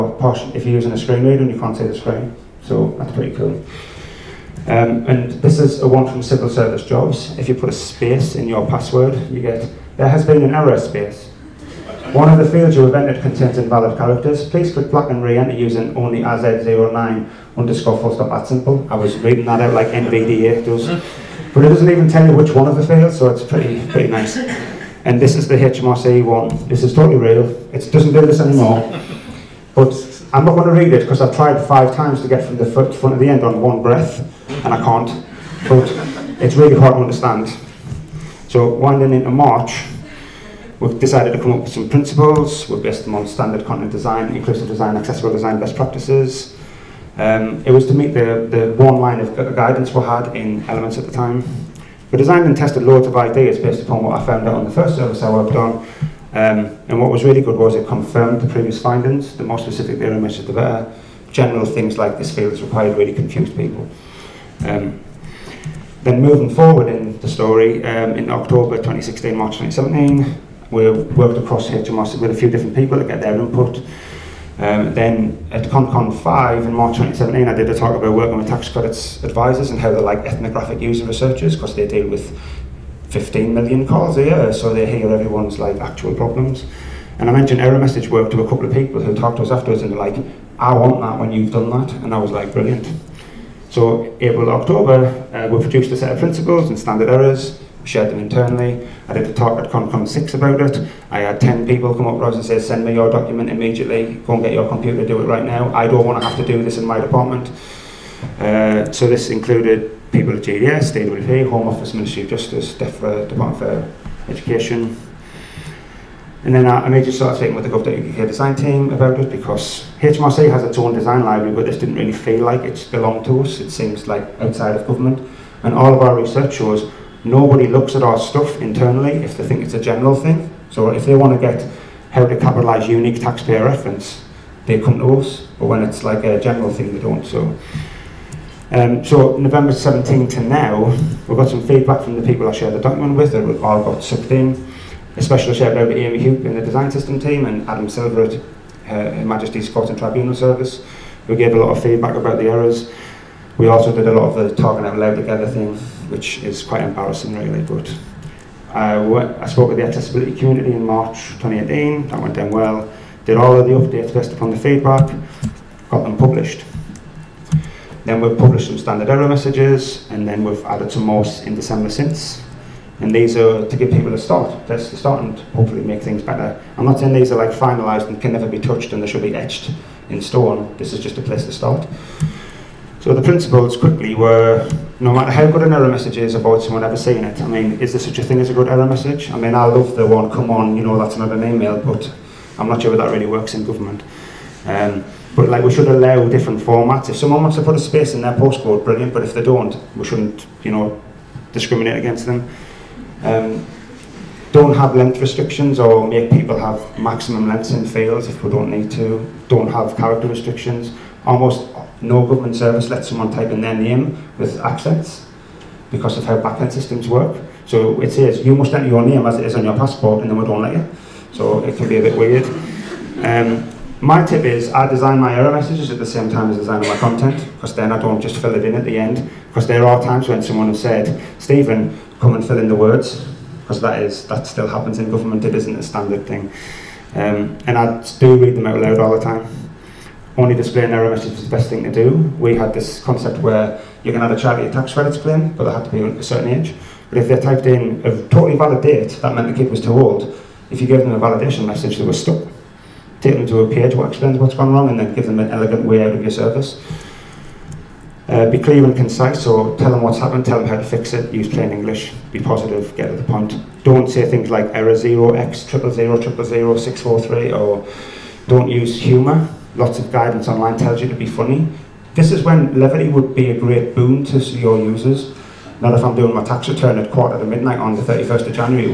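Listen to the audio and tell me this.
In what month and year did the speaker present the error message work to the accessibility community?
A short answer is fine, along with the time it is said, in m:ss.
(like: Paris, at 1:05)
March 2018, at 2:40.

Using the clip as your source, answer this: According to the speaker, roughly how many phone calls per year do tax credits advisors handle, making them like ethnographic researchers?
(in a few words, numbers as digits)
15 million.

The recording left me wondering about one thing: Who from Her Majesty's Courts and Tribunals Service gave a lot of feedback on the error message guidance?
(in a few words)
Adam Silver.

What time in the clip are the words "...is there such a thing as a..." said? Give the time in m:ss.
3:07.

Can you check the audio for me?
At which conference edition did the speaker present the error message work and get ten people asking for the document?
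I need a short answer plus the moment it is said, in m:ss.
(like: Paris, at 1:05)
ConCon 6, at 1:39.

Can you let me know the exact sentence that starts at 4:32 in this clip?
This is when levity would be a great boon to your users.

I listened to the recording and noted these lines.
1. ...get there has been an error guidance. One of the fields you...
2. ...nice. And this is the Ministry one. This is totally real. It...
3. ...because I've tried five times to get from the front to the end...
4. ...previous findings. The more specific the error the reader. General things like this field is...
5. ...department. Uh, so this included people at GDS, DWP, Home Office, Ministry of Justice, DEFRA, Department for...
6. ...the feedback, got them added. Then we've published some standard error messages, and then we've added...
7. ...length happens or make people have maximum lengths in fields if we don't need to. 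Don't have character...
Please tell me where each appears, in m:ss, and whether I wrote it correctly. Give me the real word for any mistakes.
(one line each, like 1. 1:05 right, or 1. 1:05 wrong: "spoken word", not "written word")
1. 0:09 wrong: "space", not "guidance"
2. 0:24 wrong: "HMRC", not "Ministry"
3. 0:31 right
4. 0:58 wrong: "better", not "reader"
5. 1:46 right
6. 2:44 wrong: "published", not "added"
7. 3:24 wrong: "restrictions", not "happens".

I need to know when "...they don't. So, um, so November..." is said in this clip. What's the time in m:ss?
2:16.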